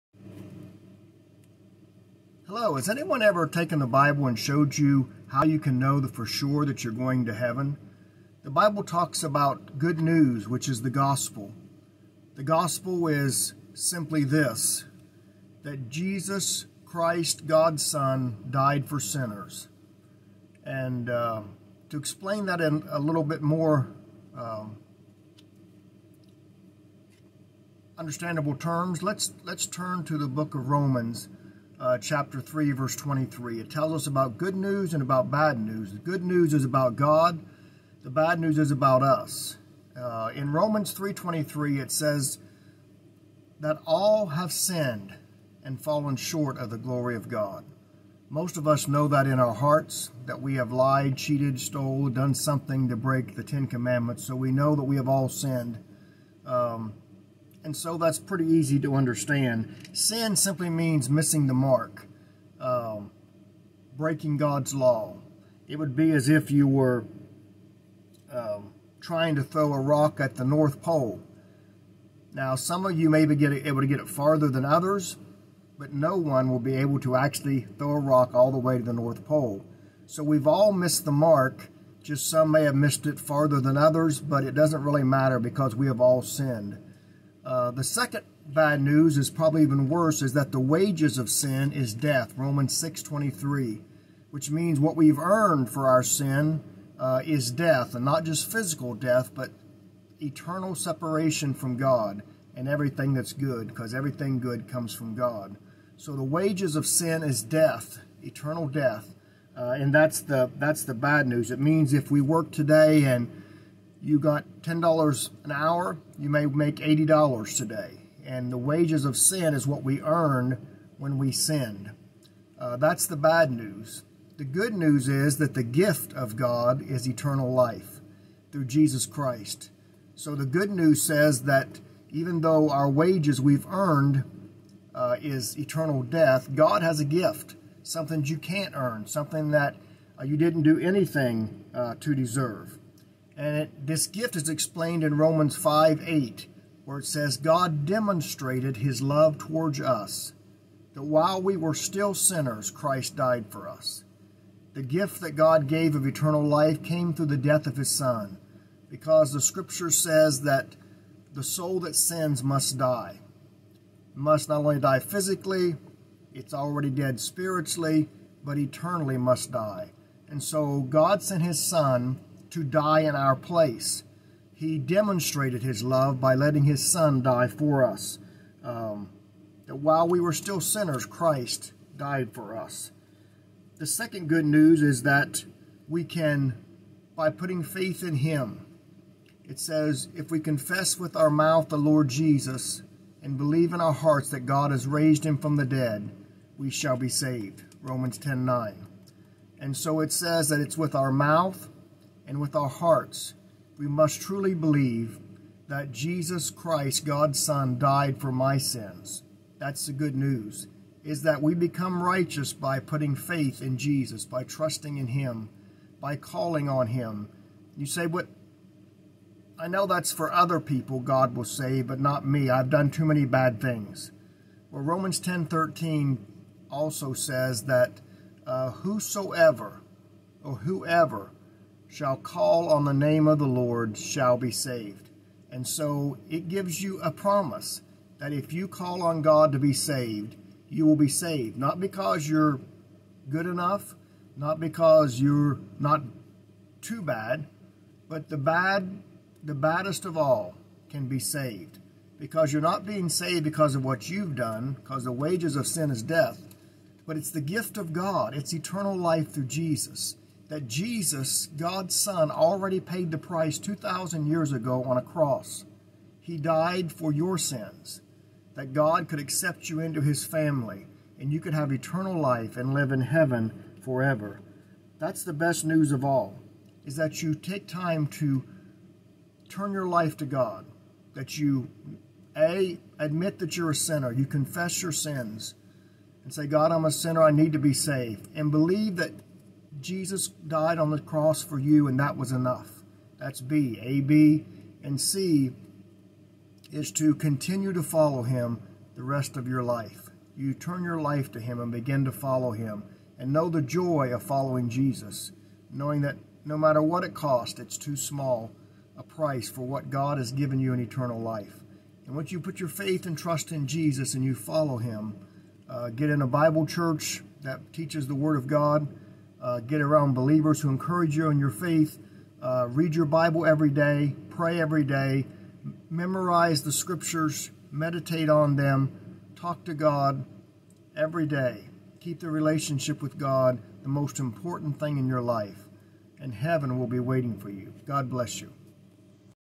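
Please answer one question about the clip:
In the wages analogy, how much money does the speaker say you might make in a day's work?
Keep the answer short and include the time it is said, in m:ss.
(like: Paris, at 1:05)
$80, at 1:56.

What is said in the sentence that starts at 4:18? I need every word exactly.
It's eternal life through Jesus that Jesus, God's Son, already paid the price 2,000 years ago on a cross.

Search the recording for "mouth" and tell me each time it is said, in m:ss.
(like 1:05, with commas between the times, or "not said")
3:11, 3:21.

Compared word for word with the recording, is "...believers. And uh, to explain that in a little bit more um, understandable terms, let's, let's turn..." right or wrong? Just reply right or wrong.
wrong.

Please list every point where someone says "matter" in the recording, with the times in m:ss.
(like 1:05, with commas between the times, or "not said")
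1:25, 5:06.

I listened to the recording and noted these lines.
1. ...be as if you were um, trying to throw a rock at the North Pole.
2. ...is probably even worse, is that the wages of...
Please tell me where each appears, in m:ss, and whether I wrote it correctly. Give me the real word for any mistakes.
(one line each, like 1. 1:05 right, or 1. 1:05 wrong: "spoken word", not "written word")
1. 1:05 right
2. 1:29 right.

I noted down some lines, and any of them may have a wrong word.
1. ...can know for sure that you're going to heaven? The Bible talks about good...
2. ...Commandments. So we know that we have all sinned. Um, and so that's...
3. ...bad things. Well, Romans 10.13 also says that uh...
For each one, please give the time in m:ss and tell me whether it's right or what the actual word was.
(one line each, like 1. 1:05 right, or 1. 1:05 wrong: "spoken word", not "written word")
1. 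0:05 right
2. 0:53 right
3. 3:43 right.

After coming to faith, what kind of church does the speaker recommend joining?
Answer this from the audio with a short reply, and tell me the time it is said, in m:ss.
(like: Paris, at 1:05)
A Bible church, at 5:16.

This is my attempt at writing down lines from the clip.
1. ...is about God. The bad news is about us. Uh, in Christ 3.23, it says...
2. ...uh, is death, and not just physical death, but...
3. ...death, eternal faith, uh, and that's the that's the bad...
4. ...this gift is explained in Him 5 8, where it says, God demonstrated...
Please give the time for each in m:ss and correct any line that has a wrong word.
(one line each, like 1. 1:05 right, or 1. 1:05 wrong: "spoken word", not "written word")
1. 0:36 wrong: "Romans", not "Christ"
2. 1:36 right
3. 1:47 wrong: "death", not "faith"
4. 2:23 wrong: "Romans", not "Him".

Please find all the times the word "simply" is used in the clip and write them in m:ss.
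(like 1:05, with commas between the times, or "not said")
0:13, 1:00.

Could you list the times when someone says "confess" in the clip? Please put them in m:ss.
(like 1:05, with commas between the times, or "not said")
3:10, 4:44.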